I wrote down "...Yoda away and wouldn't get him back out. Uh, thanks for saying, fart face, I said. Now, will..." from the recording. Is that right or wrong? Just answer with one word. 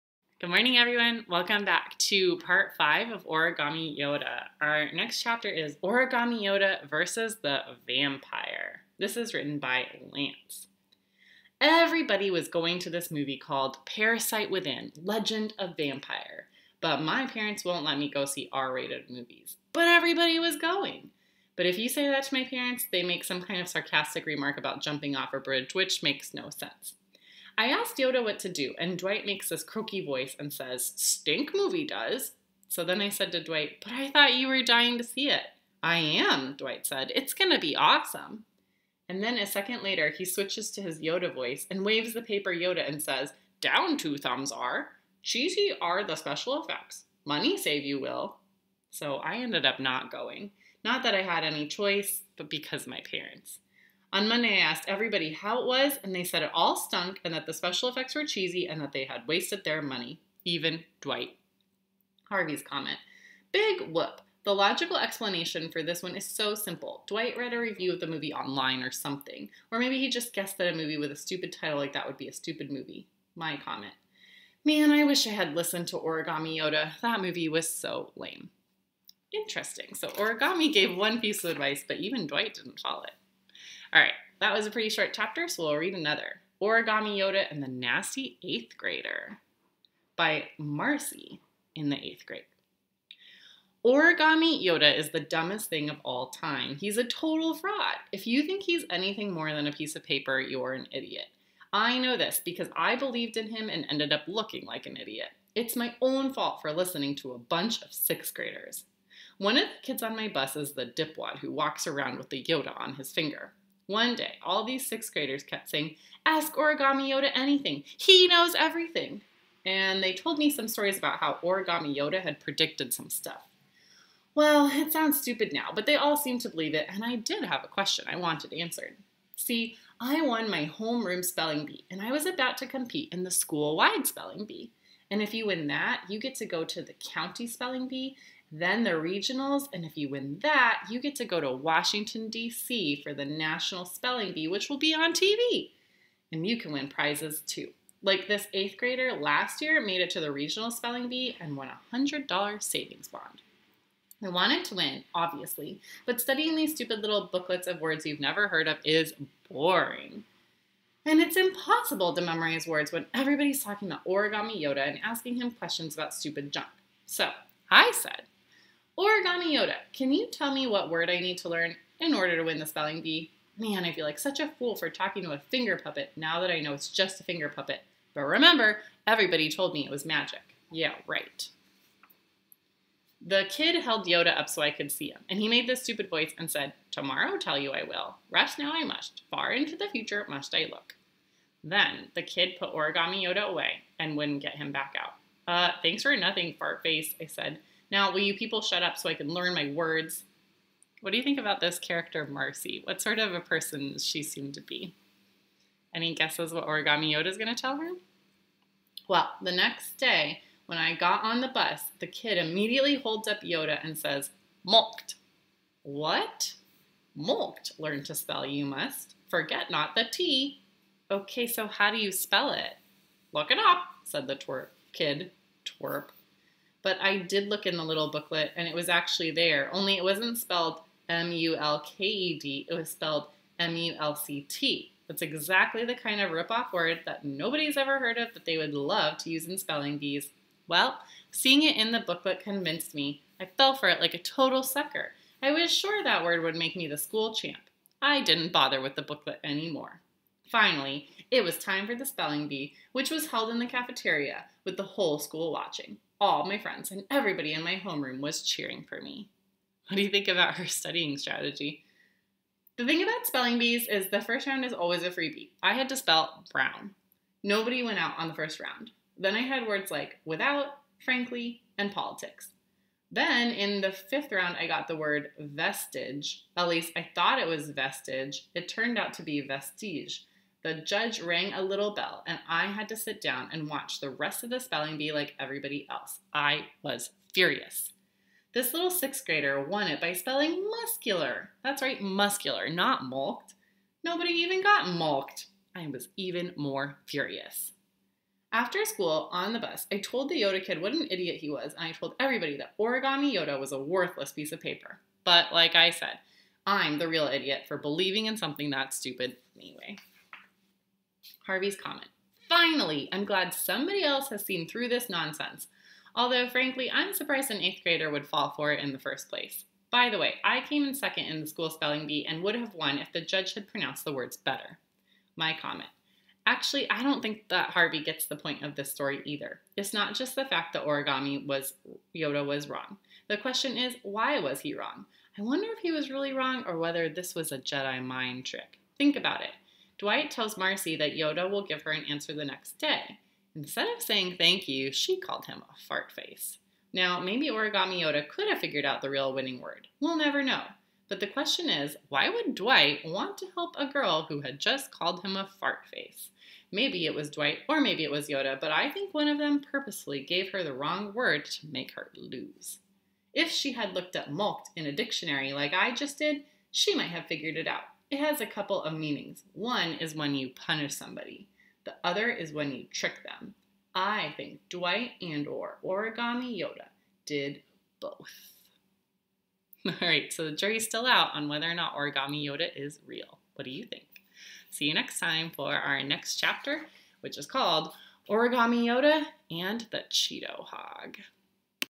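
wrong.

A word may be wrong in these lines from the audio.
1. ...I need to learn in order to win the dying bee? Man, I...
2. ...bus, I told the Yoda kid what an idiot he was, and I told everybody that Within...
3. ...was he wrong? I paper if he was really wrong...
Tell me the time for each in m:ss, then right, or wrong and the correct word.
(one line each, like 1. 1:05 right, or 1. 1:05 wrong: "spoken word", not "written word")
1. 2:51 wrong: "spelling", not "dying"
2. 4:59 wrong: "Origami", not "Within"
3. 5:34 wrong: "wonder", not "paper".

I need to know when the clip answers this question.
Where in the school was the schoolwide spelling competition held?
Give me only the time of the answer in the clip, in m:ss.
4:13.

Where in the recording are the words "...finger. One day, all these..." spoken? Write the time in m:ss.
1:53.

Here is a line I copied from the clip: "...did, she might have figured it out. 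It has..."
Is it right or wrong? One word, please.
right.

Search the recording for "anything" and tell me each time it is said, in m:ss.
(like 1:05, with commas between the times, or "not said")
1:38, 1:57.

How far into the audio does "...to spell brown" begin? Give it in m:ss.
4:25.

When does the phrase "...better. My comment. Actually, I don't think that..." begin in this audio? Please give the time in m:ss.
5:24.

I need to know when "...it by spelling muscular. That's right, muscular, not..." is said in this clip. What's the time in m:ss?
4:49.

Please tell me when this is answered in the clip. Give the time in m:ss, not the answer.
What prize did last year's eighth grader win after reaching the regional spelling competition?
2:31.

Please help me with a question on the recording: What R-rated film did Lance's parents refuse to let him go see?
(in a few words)
Parasite Within Legend of Vampire.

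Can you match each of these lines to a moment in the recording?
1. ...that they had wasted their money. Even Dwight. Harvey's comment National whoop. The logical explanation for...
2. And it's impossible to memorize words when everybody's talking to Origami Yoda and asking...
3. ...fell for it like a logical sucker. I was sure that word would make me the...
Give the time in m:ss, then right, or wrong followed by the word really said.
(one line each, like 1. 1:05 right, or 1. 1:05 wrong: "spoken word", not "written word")
1. 0:58 wrong: "Big", not "National"
2. 2:41 right
3. 4:03 wrong: "total", not "logical".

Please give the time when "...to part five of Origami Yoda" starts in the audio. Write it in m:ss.
0:01.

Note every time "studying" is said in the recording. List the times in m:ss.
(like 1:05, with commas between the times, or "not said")
2:36, 4:20.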